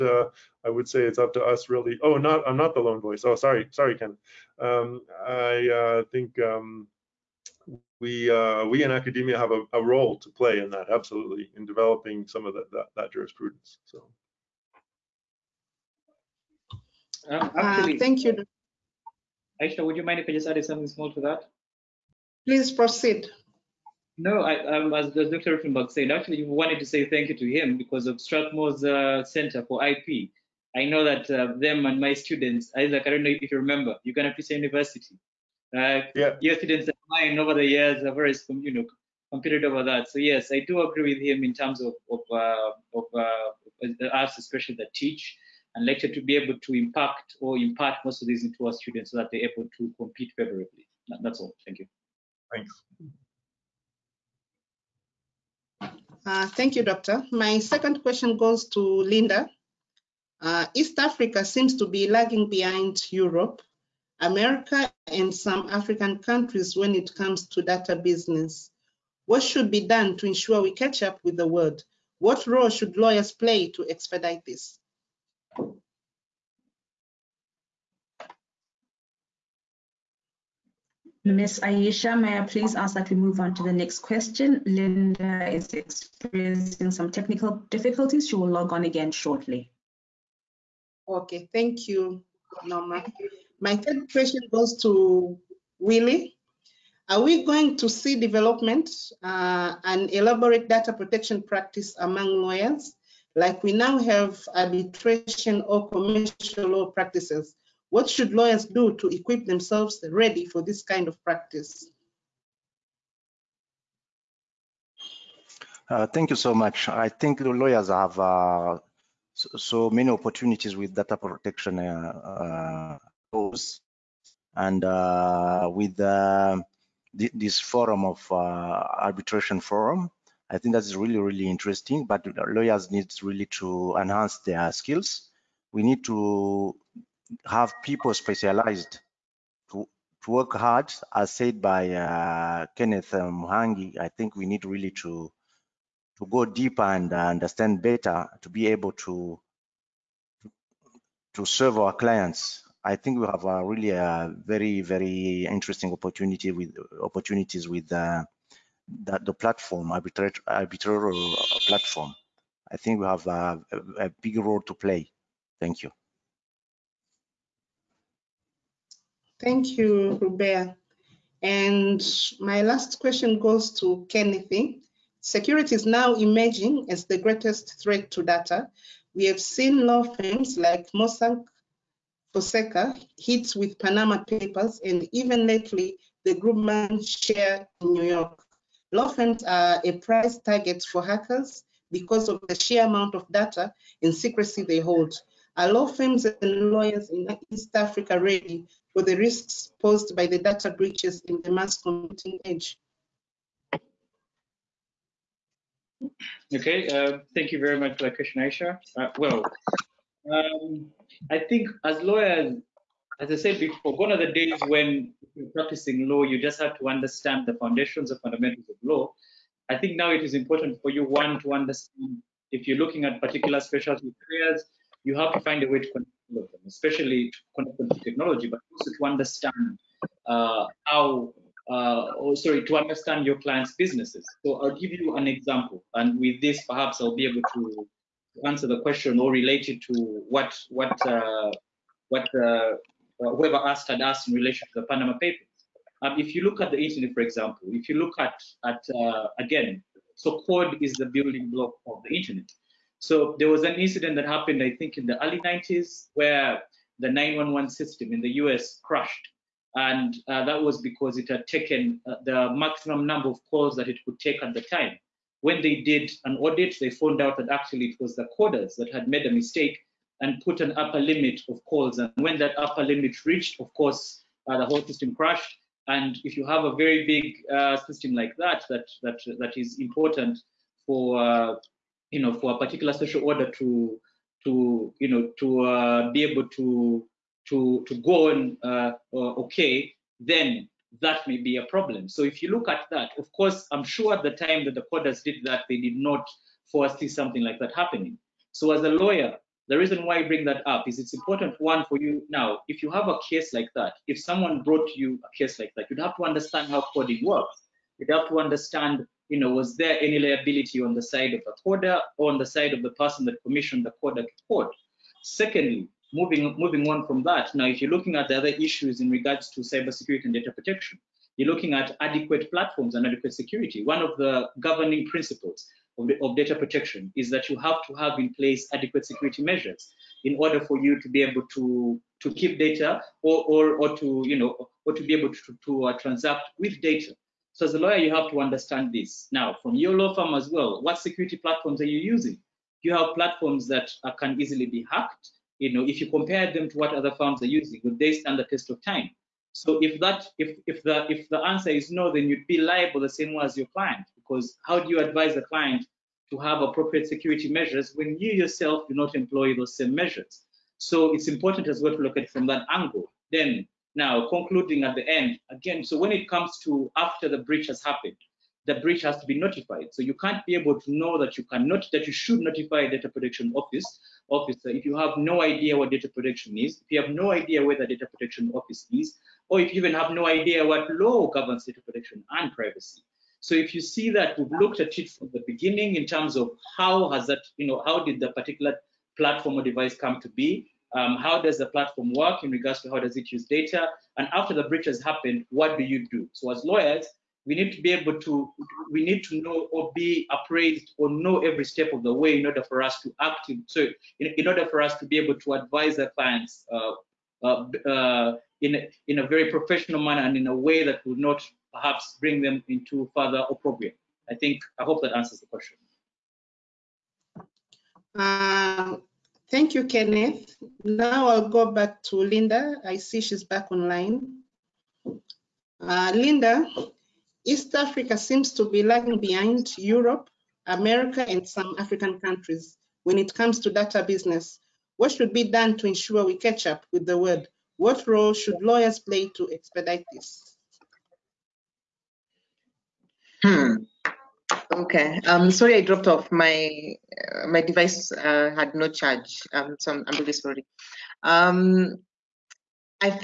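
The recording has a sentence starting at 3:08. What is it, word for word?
Law firms are a prize target for hackers because of the sheer amount of data and secrecy they hold.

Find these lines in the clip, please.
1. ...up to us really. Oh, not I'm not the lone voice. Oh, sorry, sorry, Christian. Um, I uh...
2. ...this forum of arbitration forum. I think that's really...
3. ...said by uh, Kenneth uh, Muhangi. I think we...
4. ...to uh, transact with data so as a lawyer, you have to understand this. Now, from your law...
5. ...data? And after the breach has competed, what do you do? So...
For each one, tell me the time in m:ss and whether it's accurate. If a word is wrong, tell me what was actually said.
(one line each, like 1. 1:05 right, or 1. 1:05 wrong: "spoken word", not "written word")
1. 0:01 wrong: "Ken", not "Christian"
2. 2:07 right
3. 2:21 right
4. 5:35 right
5. 6:33 wrong: "happened", not "competed".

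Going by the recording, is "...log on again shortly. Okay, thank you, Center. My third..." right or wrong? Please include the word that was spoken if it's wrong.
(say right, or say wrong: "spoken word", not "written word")
wrong: "Norma", not "Center".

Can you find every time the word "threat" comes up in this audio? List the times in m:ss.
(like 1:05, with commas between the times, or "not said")
2:57.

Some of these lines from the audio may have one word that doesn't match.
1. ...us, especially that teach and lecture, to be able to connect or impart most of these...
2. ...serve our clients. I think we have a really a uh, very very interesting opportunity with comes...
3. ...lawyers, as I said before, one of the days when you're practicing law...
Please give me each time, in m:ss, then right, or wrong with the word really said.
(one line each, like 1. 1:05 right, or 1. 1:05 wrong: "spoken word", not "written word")
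1. 0:44 wrong: "impact", not "connect"
2. 2:31 wrong: "opportunities", not "comes"
3. 3:32 right.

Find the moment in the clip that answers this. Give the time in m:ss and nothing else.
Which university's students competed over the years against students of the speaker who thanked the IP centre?
0:34.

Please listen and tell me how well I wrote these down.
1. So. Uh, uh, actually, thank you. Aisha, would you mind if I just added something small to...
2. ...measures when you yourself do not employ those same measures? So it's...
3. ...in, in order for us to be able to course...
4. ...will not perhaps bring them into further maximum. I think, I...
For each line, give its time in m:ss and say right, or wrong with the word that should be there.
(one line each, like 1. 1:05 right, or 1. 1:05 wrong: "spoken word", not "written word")
1. 0:13 right
2. 5:57 right
3. 6:44 wrong: "advise", not "course"
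4. 6:51 wrong: "opprobrium", not "maximum".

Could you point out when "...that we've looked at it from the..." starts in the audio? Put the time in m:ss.
6:24.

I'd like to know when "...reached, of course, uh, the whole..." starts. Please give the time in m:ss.
4:33.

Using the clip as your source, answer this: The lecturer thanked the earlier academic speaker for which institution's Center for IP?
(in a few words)
Strathmore.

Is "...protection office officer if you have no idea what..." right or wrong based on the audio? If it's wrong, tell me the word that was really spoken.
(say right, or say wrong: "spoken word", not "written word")
right.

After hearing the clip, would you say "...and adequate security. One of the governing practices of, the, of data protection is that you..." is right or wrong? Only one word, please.
wrong.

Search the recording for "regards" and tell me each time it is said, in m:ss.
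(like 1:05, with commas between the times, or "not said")
5:19, 6:32.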